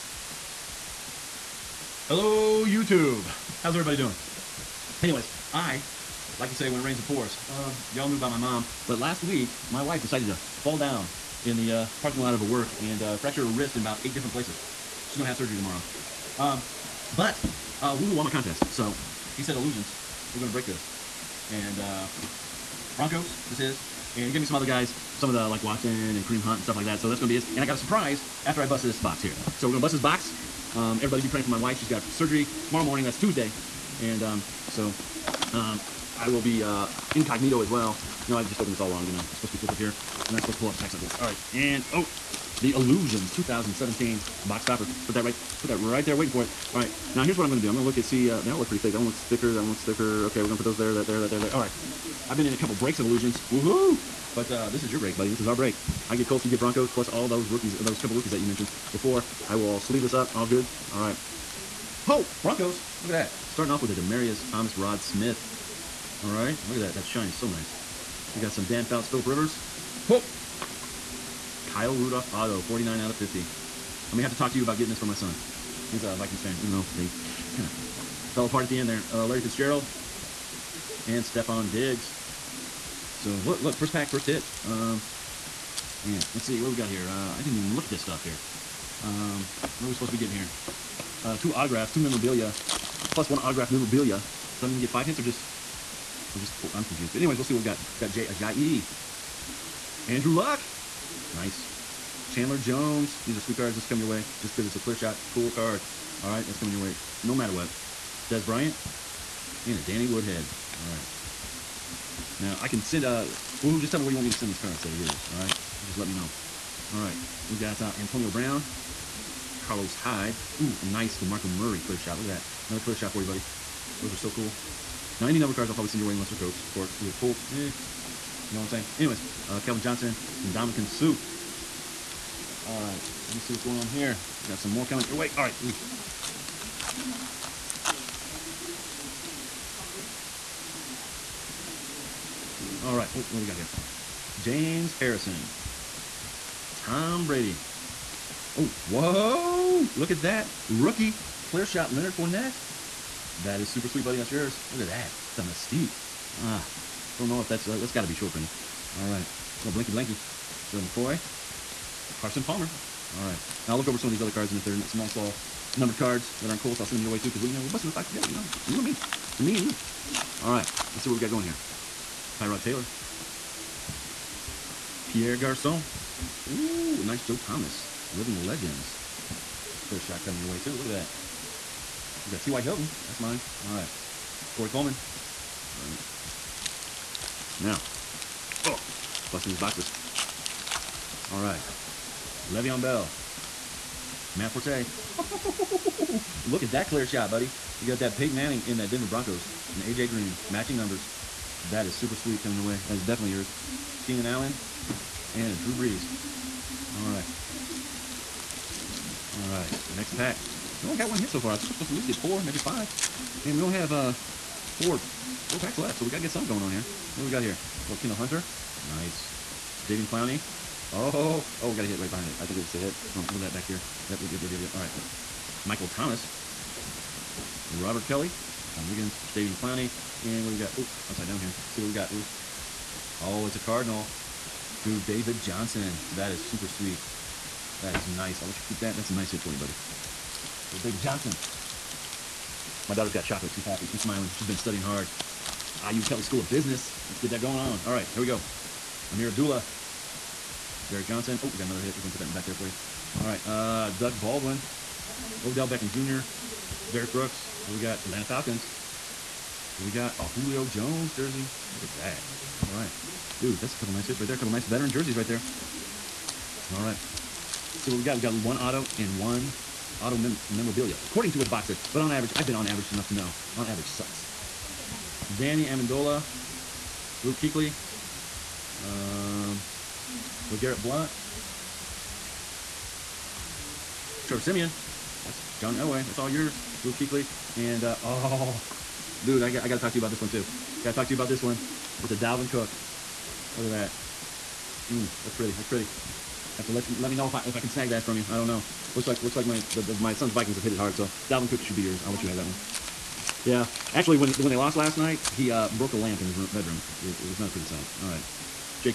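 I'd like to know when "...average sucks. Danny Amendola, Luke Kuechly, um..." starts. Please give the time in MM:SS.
04:33.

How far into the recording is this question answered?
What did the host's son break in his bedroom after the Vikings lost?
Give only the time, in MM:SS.
05:05.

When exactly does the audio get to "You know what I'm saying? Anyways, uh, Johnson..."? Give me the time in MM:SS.
02:07.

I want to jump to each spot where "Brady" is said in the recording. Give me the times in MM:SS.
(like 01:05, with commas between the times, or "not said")
02:27.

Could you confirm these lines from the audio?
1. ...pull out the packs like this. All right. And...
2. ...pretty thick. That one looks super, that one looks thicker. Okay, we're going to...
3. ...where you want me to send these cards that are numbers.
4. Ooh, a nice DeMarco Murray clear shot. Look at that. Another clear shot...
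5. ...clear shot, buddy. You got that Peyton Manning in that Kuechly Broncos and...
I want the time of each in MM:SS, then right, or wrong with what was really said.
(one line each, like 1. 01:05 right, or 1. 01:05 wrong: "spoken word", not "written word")
1. 00:40 right
2. 00:48 wrong: "thicker", not "super"
3. 01:54 wrong: "yours", not "numbers"
4. 02:00 right
5. 03:16 wrong: "Denver", not "Kuechly".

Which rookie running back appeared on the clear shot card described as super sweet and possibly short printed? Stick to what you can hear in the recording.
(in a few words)
Leonard Fournette.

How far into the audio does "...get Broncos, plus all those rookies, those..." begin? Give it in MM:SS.
00:56.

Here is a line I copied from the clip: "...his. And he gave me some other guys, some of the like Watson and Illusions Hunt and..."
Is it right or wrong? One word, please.
wrong.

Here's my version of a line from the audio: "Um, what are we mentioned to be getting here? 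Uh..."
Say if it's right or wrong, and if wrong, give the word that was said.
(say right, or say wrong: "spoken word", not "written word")
wrong: "supposed", not "mentioned".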